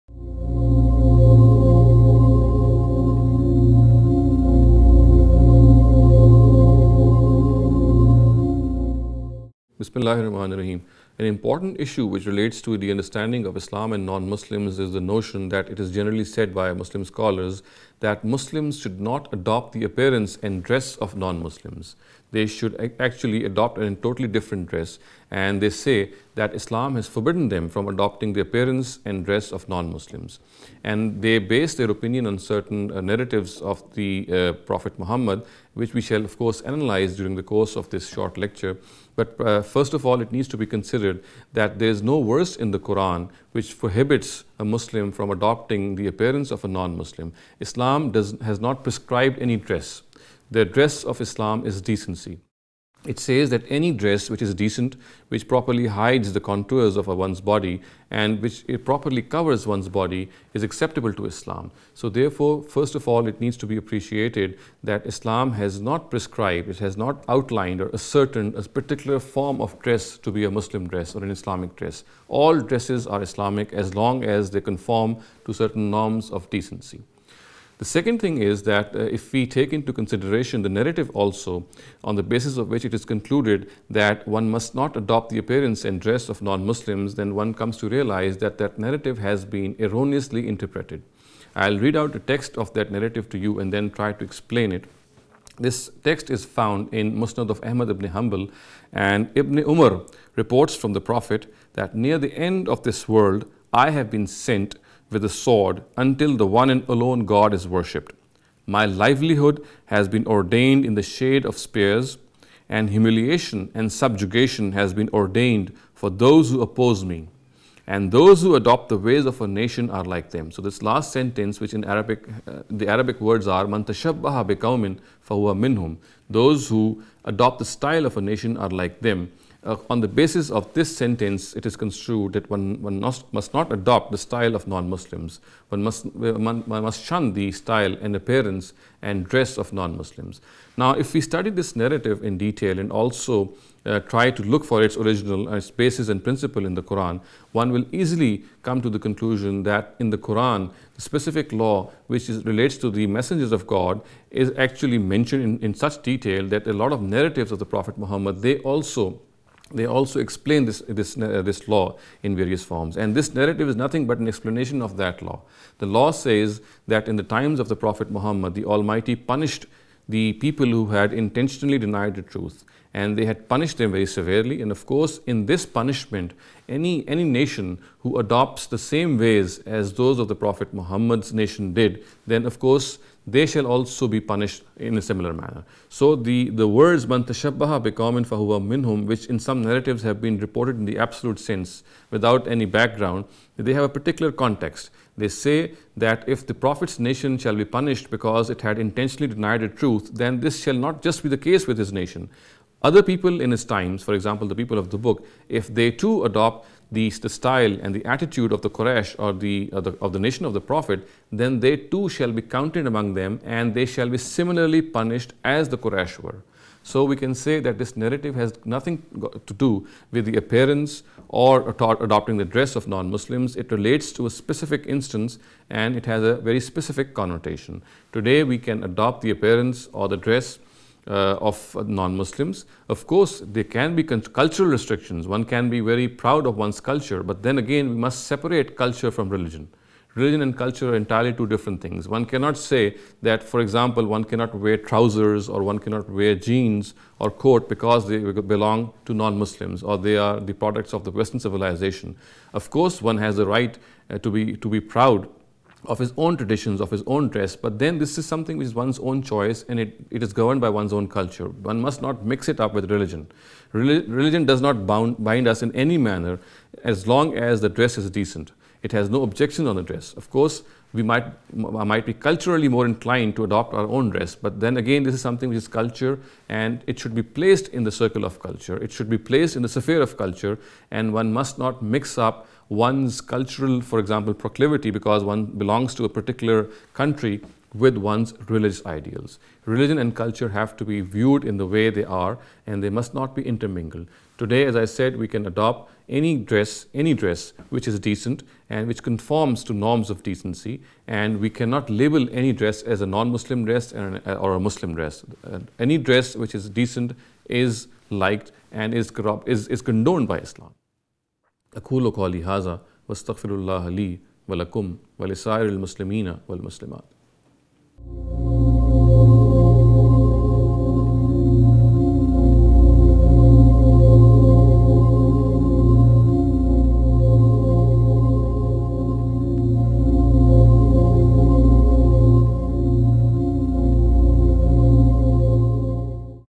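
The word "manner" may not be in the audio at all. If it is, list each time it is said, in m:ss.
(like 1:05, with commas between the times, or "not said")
3:05, 4:25.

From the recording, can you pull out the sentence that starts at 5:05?
Uh, any dress which is decent is liked and is, corrupt, is, is condoned by Islam.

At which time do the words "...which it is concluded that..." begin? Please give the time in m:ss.
1:22.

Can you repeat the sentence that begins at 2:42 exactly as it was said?
And this narrative is nothing but an explanation of that law.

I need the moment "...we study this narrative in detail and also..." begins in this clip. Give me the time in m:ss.
2:21.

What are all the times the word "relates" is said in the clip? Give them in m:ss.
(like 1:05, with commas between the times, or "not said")
0:12, 2:32, 3:43.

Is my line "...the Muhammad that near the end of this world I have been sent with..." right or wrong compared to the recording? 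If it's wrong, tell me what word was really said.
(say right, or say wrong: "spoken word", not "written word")
wrong: "Prophet", not "Muhammad".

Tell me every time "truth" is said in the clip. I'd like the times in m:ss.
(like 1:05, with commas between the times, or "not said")
2:52, 3:19.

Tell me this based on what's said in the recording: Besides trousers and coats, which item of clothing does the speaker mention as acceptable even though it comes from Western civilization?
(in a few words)
jeans.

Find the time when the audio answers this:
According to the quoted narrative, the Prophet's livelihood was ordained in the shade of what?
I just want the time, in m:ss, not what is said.
1:51.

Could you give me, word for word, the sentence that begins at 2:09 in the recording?
Uh, on the basis of this sentence, it is construed that one, one must, must not adopt the style of non-Muslims.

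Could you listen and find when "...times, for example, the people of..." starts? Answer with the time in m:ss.
3:23.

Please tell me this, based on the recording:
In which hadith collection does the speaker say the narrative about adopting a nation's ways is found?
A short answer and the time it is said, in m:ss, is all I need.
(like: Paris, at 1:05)
Musnad of Ahmad ibn Hanbal, at 1:37.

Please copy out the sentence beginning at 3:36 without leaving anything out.
So we can say that this narrative has nothing to do with the appearance or adopting the dress of non-Muslims.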